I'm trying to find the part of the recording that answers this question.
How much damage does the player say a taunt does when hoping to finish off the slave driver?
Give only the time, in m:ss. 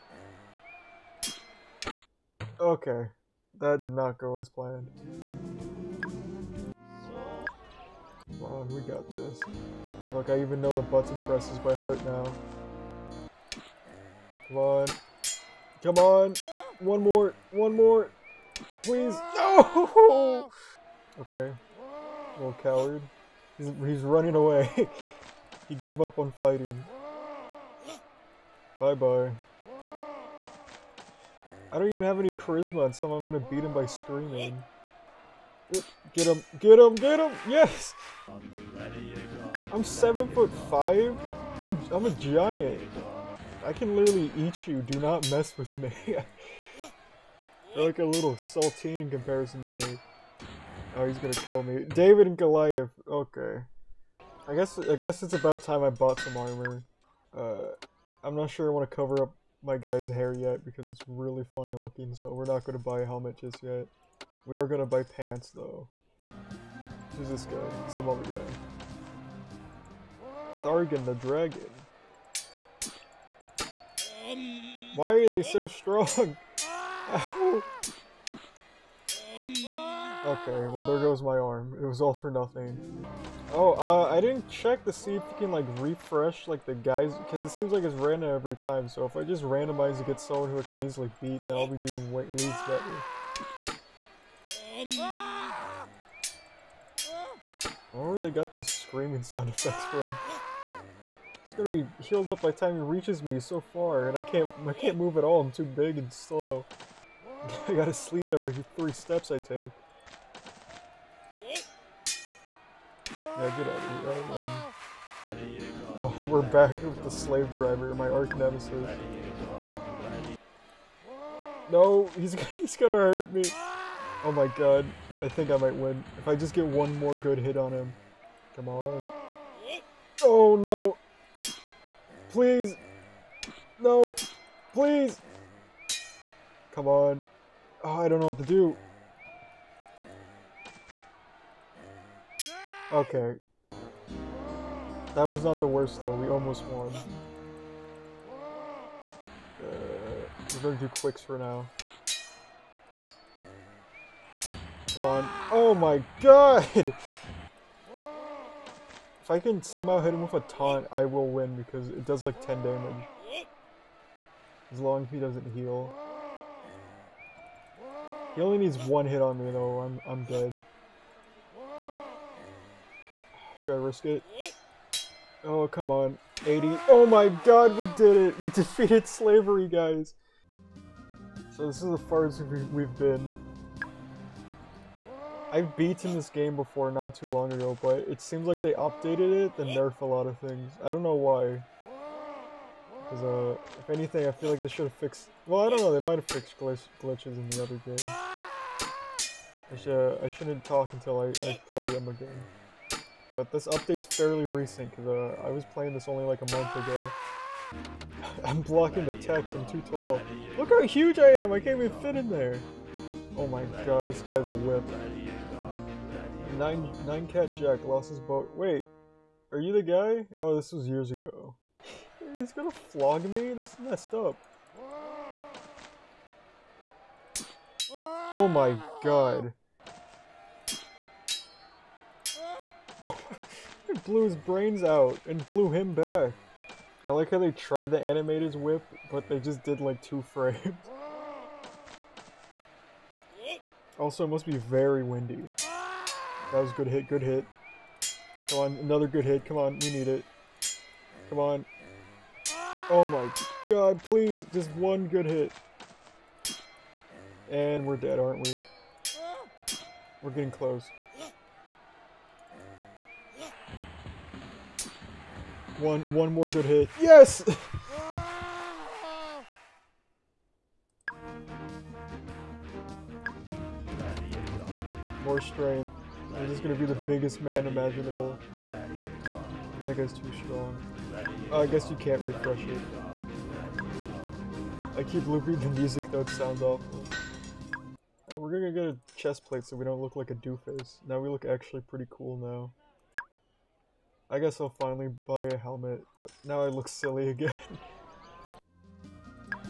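2:42.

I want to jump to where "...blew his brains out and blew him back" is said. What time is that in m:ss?
3:54.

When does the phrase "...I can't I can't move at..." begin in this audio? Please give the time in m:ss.
1:44.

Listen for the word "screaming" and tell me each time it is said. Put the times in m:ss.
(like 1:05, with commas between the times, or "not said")
0:33, 1:38.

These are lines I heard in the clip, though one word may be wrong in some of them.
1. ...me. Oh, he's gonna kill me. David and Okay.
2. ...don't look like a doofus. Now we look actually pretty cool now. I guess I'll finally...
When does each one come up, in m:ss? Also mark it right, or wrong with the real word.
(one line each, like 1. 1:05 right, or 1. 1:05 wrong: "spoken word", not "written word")
1. 0:49 wrong: "Goliath", not "Okay"
2. 4:49 right.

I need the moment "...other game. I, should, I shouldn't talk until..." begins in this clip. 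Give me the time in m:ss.
3:17.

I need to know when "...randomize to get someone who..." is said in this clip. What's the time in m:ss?
1:29.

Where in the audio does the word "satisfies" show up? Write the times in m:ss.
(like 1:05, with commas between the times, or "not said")
not said.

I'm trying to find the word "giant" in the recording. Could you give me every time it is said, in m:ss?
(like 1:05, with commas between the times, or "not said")
0:42.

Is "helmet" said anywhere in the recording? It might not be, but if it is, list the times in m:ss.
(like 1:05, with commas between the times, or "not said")
1:03, 4:55.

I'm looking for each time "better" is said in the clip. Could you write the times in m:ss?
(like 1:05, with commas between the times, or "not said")
1:32.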